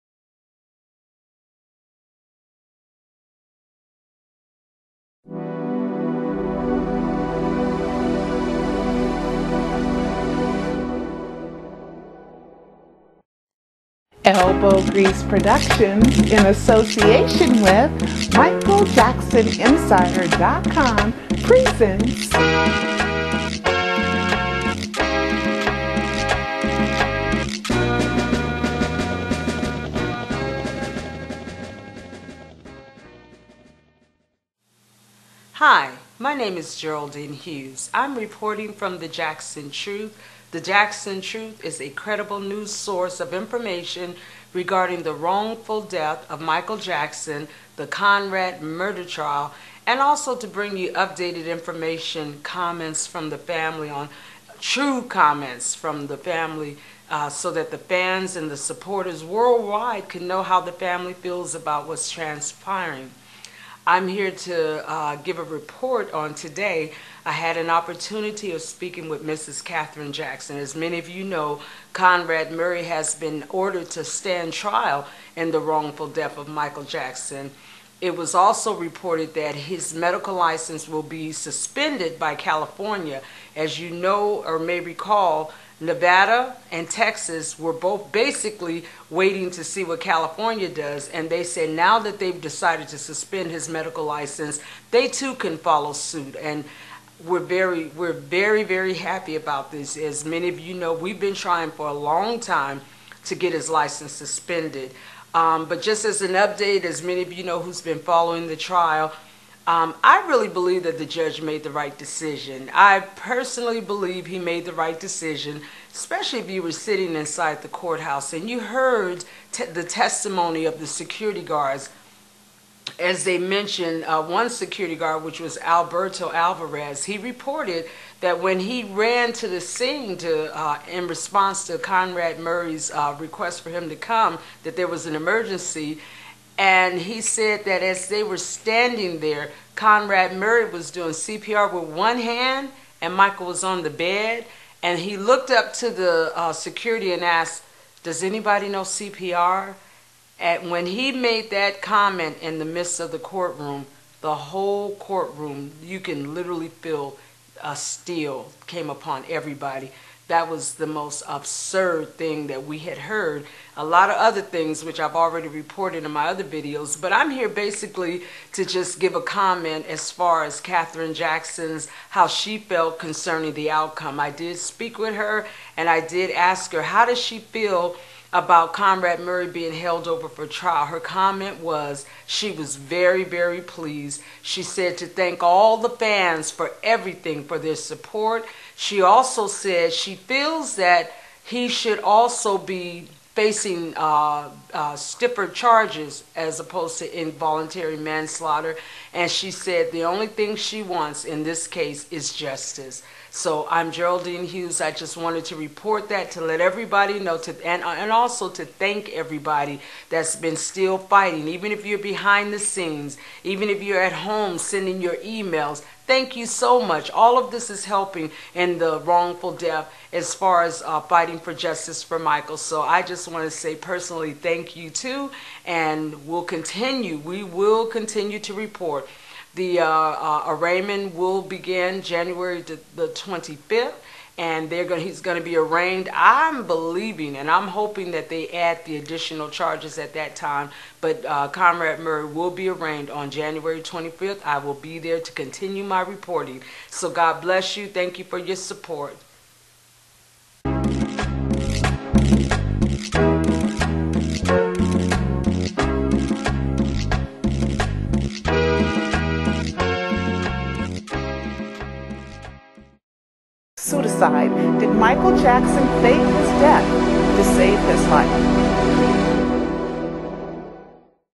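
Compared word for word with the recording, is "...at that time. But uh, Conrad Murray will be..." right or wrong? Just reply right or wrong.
right.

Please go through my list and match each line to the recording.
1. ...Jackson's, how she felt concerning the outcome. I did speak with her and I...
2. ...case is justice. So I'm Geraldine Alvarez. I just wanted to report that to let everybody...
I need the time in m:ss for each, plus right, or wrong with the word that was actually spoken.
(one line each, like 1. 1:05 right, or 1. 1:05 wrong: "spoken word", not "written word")
1. 2:51 right
2. 3:21 wrong: "Hughes", not "Alvarez".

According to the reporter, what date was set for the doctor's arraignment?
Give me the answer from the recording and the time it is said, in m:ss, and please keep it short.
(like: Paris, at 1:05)
January 25, at 3:52.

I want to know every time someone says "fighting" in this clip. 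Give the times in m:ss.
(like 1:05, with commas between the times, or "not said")
3:30, 3:40.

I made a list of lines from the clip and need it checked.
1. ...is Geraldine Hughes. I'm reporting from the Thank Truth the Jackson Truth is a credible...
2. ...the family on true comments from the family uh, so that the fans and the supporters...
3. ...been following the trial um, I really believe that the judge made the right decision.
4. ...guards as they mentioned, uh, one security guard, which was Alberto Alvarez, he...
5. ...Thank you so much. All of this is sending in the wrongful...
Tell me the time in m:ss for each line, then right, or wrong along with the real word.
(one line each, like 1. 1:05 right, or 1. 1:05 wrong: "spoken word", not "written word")
1. 0:36 wrong: "Jackson", not "Thank"
2. 0:53 right
3. 1:47 right
4. 2:01 right
5. 3:36 wrong: "helping", not "sending".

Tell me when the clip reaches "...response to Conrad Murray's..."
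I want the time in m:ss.
2:11.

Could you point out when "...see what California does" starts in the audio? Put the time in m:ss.
1:29.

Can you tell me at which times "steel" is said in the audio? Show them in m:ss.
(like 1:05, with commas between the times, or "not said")
2:37.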